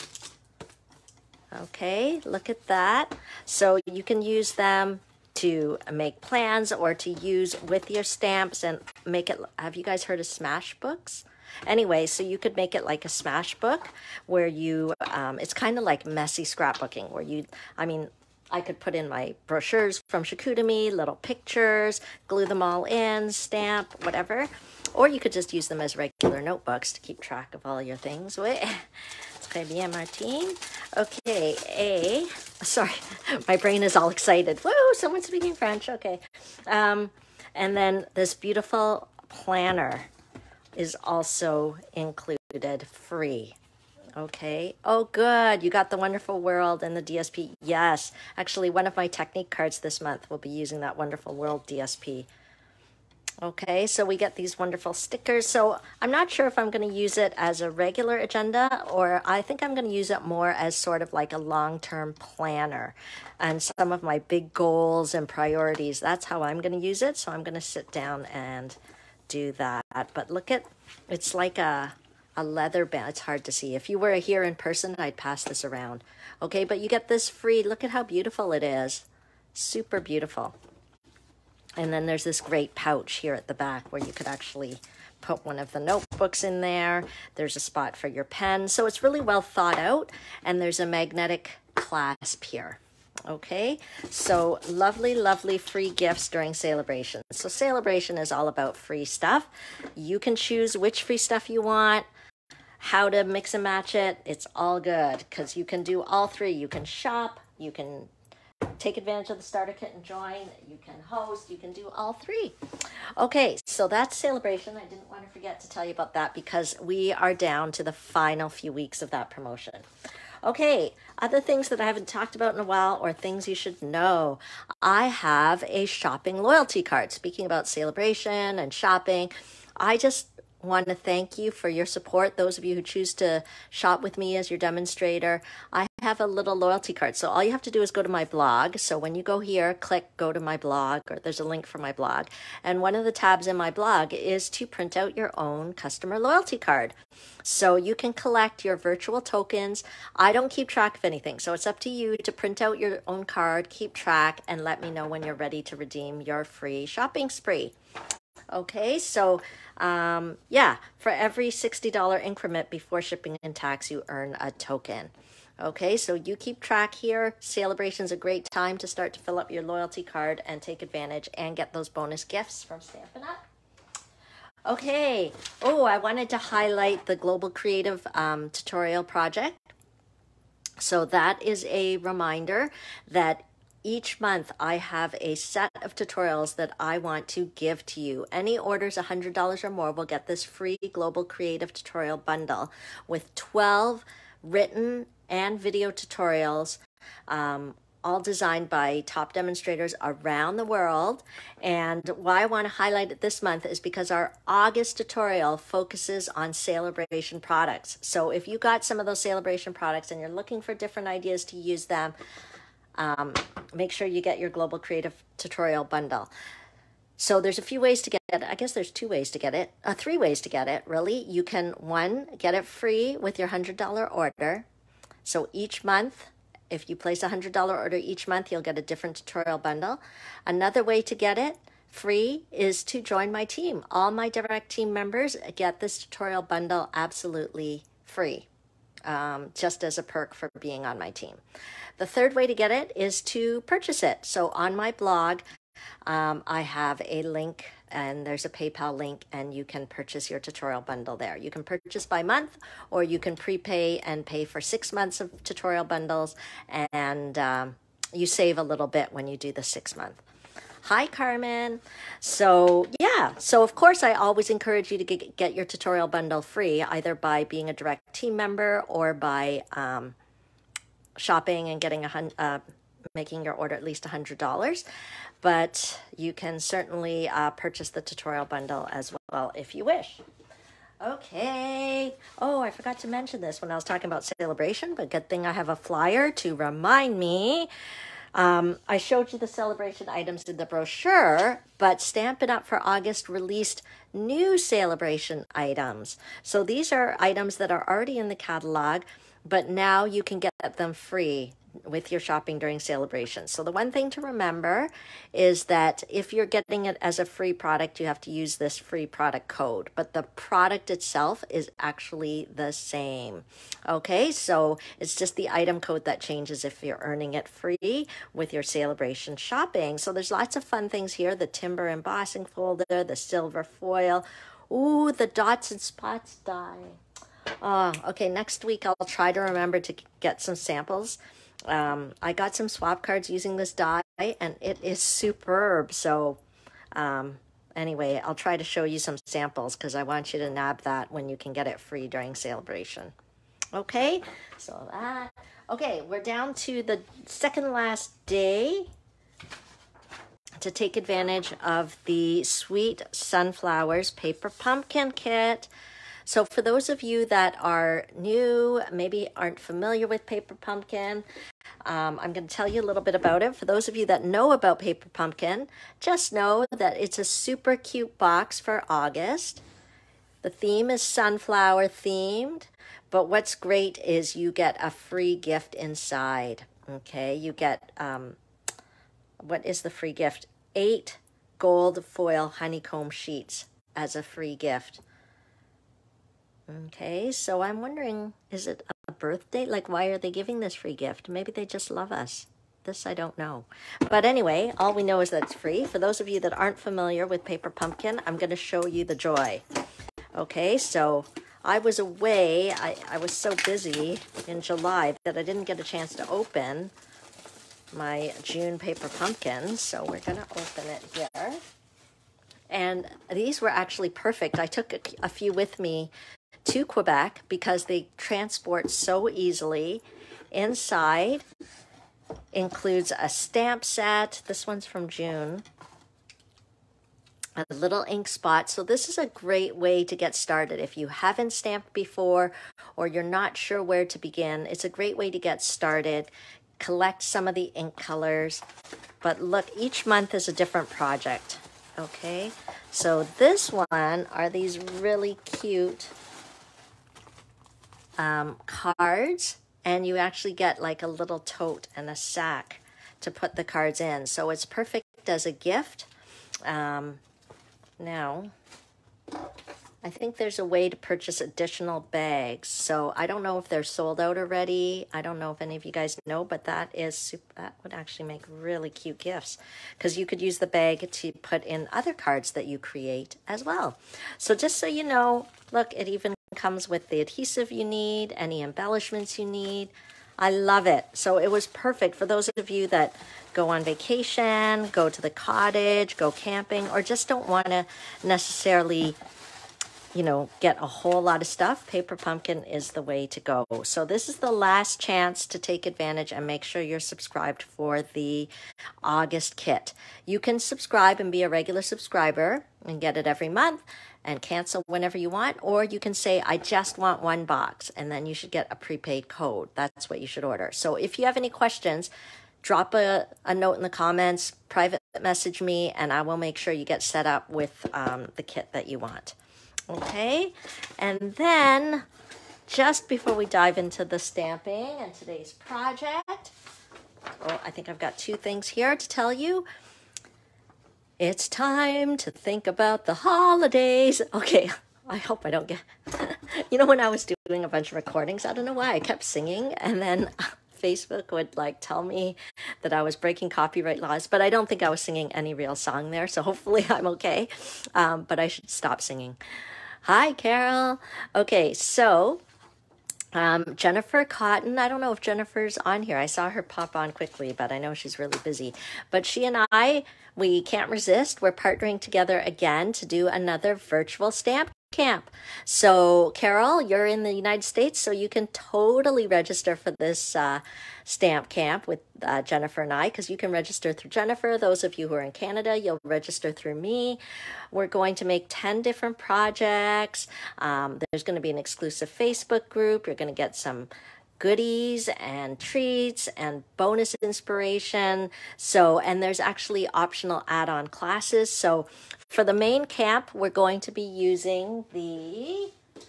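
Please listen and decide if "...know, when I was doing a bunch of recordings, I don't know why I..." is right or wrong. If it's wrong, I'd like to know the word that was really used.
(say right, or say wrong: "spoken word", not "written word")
right.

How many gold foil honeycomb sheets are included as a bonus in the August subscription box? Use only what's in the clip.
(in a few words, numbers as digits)
8.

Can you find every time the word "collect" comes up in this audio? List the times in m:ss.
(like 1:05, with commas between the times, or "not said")
2:28, 7:16.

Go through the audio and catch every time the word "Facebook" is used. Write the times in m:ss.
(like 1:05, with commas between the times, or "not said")
9:00, 9:42.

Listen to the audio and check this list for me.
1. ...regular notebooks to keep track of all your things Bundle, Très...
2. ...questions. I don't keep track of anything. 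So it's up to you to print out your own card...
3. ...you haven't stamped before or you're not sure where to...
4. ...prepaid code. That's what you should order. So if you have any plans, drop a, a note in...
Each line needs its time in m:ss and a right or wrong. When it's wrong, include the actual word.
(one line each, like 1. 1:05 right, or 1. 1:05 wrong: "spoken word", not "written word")
1. 0:25 wrong: "Wait", not "Bundle"
2. 2:29 wrong: "tokens", not "questions"
3. 7:10 right
4. 8:28 wrong: "questions", not "plans".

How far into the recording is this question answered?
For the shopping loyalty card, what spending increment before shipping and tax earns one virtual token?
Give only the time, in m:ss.
2:41.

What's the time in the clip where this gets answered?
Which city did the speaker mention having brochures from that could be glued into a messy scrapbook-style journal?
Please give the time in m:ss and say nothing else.
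0:20.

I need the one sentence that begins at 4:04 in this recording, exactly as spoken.
So on my blog, um, I have a link and there's a PayPal link and you can purchase your tutorial bundle there.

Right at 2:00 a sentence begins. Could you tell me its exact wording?
Okay, other things that I haven't talked about in a while or things you should know.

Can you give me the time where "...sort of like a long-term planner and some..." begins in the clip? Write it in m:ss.
1:00.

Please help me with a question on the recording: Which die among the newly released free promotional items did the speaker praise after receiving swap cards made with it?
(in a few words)
dots and spots die.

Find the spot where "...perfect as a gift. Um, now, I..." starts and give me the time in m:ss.
7:34.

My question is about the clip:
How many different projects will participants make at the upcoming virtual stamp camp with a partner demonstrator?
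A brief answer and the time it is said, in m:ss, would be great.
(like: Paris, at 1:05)
10, at 9:38.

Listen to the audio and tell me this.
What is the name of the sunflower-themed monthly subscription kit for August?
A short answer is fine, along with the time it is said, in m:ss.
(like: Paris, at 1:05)
Sweet Sunflowers, at 5:52.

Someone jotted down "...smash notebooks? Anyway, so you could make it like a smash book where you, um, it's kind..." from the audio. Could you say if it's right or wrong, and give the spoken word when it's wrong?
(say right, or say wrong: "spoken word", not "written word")
wrong: "books", not "notebooks".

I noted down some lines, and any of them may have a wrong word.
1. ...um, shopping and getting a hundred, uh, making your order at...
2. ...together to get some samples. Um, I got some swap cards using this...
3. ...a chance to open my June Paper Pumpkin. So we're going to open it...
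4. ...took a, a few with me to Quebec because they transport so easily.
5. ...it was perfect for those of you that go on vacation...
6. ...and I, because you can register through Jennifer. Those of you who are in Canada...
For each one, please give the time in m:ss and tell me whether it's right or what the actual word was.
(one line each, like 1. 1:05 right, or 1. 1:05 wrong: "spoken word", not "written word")
1. 4:29 right
2. 5:29 wrong: "remember", not "together"
3. 6:45 right
4. 6:54 right
5. 8:01 right
6. 9:32 right.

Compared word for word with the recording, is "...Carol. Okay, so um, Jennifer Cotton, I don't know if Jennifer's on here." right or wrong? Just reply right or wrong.
right.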